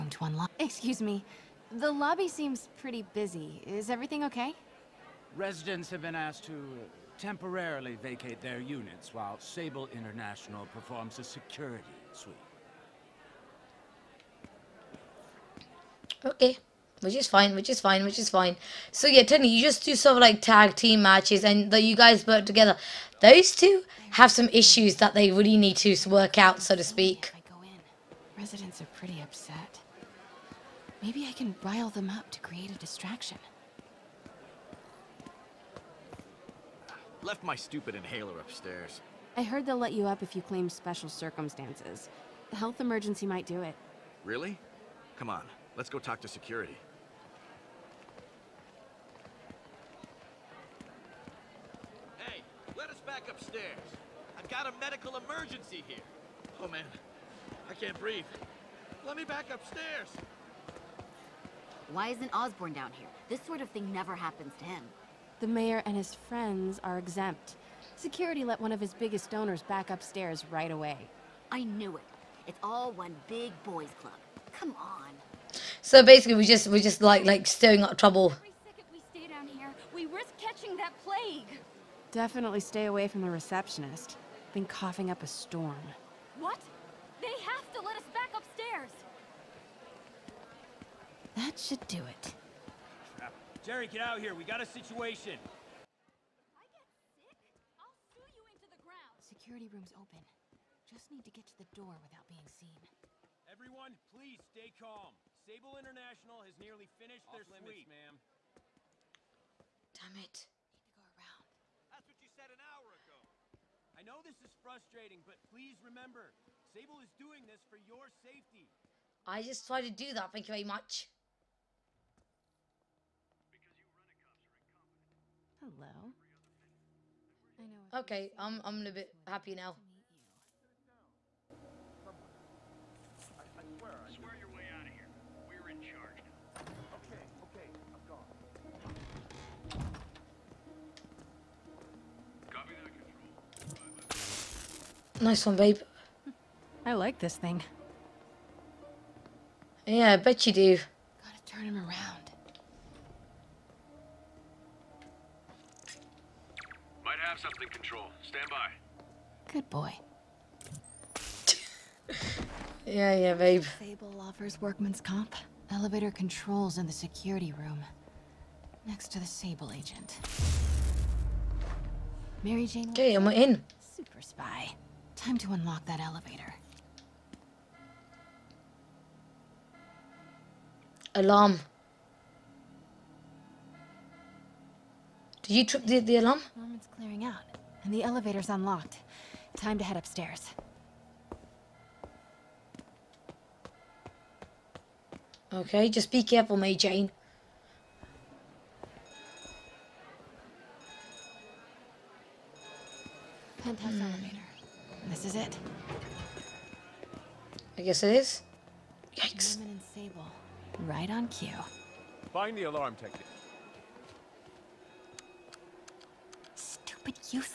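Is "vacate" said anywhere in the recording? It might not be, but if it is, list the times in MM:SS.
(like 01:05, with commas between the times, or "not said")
00:08.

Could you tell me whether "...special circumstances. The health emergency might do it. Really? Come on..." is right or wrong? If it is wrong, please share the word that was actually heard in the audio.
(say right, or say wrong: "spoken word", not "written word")
right.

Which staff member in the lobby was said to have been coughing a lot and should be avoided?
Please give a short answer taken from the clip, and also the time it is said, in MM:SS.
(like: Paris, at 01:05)
The receptionist, at 01:23.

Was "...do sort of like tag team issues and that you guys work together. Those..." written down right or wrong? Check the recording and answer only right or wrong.
wrong.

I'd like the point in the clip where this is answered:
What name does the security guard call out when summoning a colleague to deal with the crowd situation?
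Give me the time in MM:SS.
01:33.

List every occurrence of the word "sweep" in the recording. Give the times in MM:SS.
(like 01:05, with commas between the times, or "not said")
00:12, 01:47.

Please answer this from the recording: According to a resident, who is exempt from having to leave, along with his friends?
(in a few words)
The mayor.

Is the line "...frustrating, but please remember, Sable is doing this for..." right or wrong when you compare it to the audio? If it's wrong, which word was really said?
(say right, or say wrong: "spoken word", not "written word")
right.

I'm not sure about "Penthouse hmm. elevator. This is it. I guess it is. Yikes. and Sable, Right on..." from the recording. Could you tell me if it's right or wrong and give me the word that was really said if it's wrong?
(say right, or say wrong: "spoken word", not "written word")
right.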